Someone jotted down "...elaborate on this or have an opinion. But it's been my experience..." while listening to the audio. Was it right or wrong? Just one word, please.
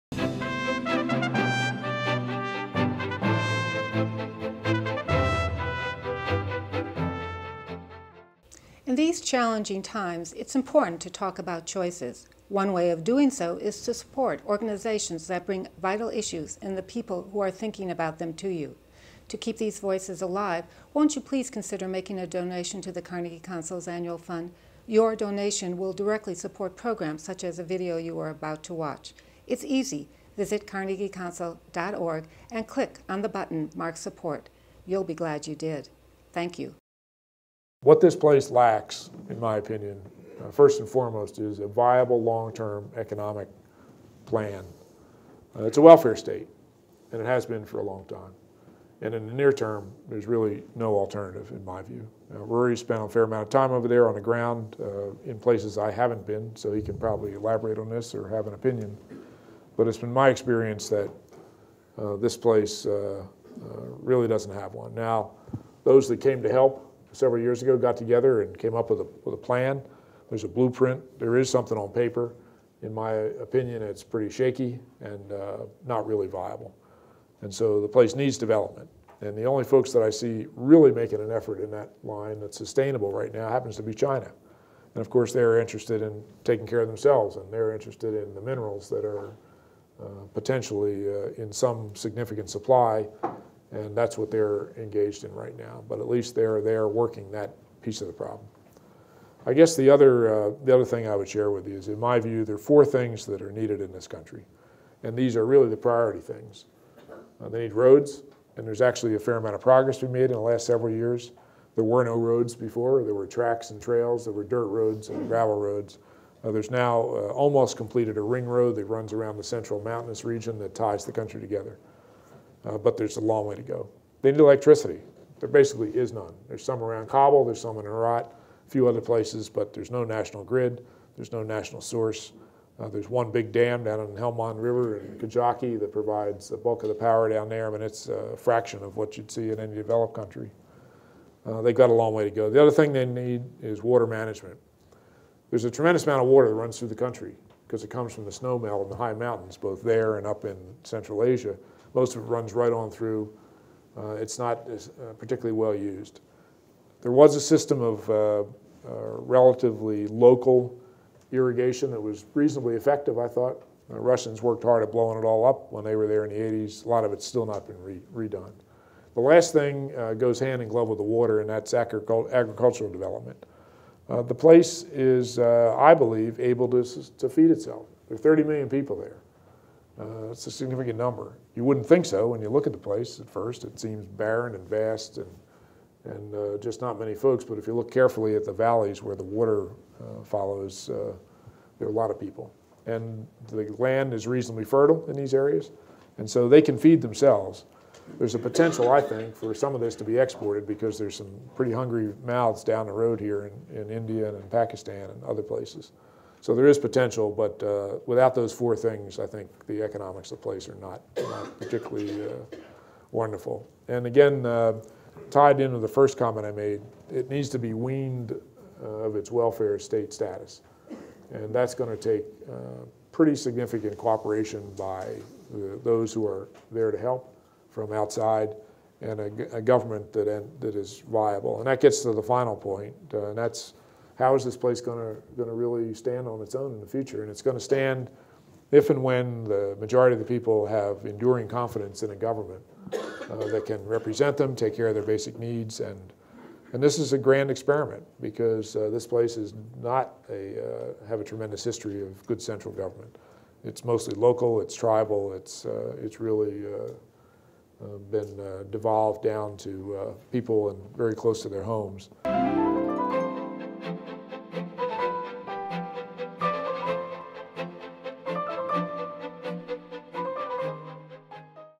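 right.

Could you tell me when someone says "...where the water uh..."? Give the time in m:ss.
3:09.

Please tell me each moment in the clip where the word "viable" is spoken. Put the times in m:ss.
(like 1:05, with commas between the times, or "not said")
0:41, 1:16, 3:51.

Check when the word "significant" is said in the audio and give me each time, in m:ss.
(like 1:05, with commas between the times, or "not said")
1:31, 3:00, 3:43.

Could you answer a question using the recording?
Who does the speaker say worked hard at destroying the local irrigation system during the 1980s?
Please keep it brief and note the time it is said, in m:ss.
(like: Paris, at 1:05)
The Russians, at 2:43.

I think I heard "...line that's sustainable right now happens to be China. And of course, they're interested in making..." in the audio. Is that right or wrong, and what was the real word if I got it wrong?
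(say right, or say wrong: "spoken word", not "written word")
wrong: "taking", not "making".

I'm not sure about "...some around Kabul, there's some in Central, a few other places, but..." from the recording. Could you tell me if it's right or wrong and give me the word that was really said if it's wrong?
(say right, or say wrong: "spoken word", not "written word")
wrong: "Herat", not "Central".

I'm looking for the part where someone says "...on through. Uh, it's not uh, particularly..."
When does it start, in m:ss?
2:32.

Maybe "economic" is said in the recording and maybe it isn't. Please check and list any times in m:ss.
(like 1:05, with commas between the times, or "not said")
0:42, 3:29.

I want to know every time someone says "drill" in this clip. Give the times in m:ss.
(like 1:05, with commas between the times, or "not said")
not said.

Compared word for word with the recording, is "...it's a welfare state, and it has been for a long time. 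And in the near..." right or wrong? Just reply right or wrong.
right.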